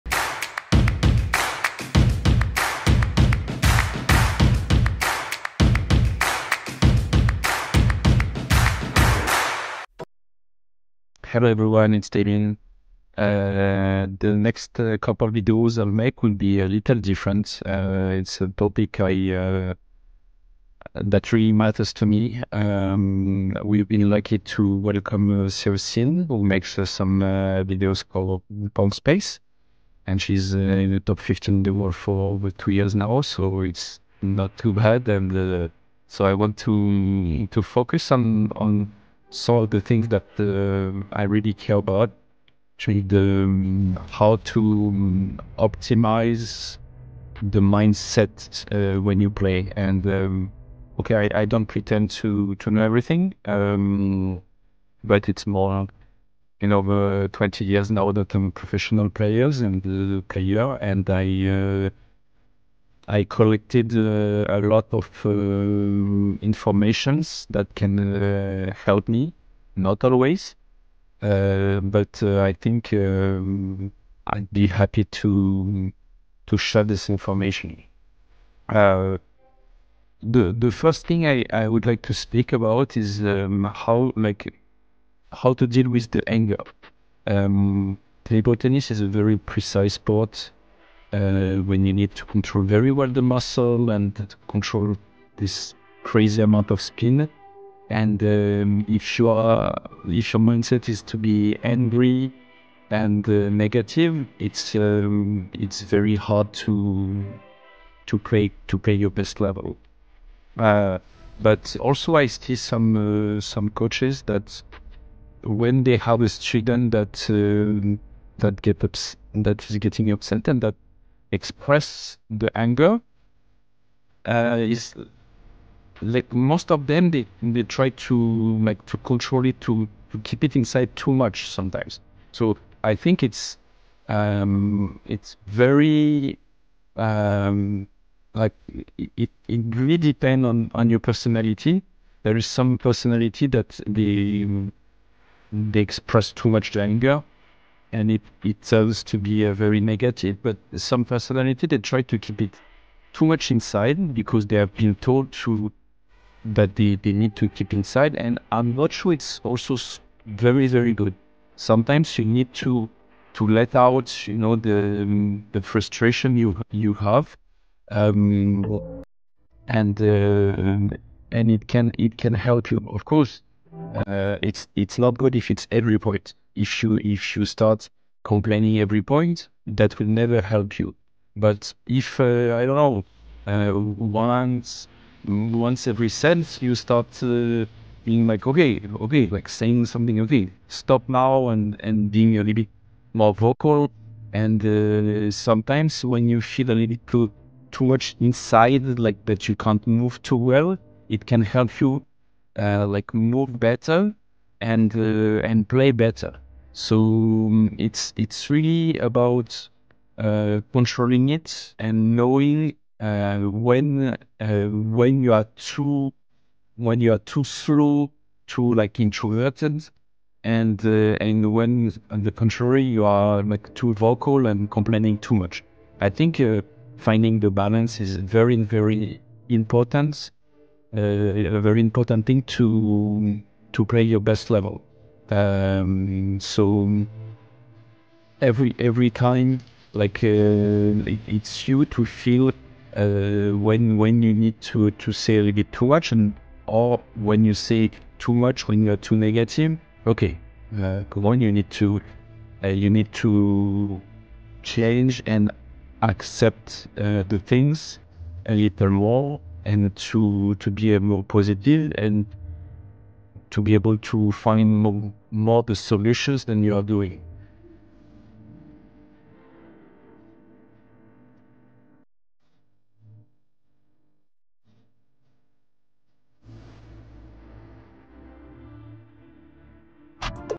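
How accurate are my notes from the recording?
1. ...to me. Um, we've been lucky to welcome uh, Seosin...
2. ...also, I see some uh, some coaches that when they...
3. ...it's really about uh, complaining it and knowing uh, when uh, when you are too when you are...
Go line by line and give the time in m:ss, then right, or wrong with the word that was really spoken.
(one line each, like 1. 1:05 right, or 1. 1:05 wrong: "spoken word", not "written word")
1. 0:21 right
2. 1:51 right
3. 3:28 wrong: "controlling", not "complaining".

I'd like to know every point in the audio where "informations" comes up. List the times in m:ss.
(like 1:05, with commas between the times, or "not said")
1:06, 1:17.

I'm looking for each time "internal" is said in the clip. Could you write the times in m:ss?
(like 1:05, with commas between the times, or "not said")
not said.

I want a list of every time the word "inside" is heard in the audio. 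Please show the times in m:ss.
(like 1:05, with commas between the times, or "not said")
2:10, 2:33, 2:37, 3:18.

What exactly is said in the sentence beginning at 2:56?
If you if you start complaining every point, that will never help you.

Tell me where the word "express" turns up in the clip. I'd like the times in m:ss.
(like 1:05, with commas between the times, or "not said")
2:01, 2:25.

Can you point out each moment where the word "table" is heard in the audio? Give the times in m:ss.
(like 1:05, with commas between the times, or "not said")
1:28.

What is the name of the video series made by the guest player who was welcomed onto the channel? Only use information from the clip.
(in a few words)
PongSpace.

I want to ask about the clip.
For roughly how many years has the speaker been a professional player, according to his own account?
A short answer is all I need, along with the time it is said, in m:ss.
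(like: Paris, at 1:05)
Over 20 years, at 0:56.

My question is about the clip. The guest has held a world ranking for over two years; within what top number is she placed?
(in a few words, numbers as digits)
15.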